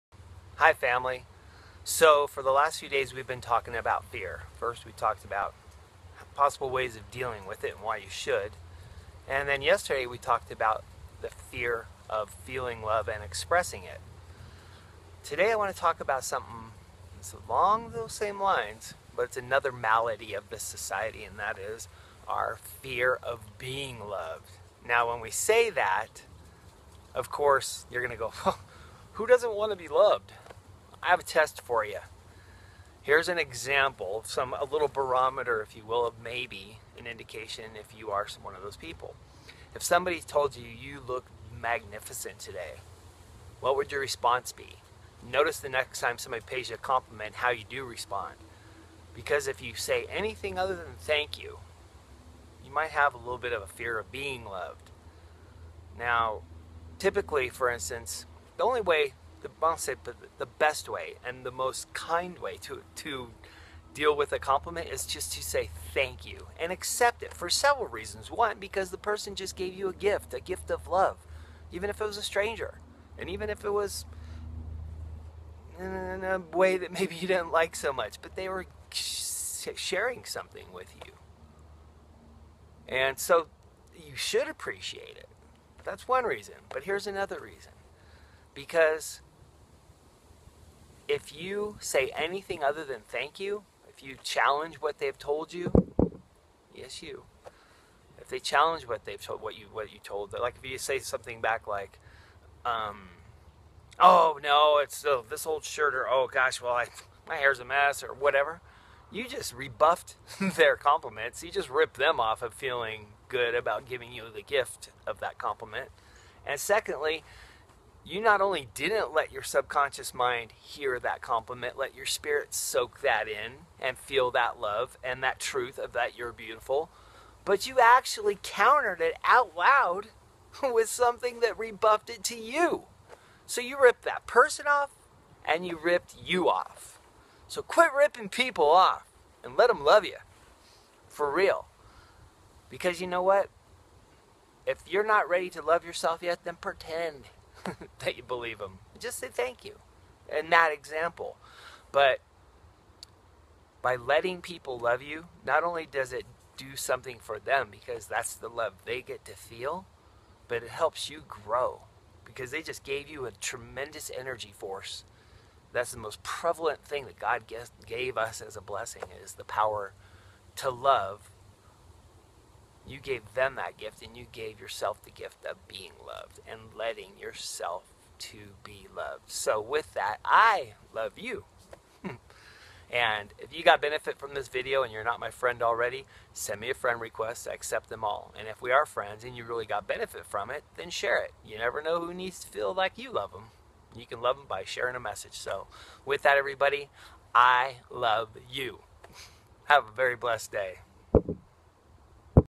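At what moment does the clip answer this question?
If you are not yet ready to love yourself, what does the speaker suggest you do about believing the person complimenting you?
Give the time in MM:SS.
02:26.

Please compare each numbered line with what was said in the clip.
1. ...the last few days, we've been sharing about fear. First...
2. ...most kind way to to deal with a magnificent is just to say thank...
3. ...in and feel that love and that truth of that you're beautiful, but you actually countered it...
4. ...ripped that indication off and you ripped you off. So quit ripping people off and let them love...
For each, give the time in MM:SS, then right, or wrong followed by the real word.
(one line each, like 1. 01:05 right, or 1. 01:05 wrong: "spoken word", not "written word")
1. 00:02 wrong: "talking", not "sharing"
2. 01:01 wrong: "compliment", not "magnificent"
3. 02:03 right
4. 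02:13 wrong: "person", not "indication".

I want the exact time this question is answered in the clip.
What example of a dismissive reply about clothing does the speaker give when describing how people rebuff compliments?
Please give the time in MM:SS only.
01:45.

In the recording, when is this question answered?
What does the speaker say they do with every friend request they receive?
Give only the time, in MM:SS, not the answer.
03:07.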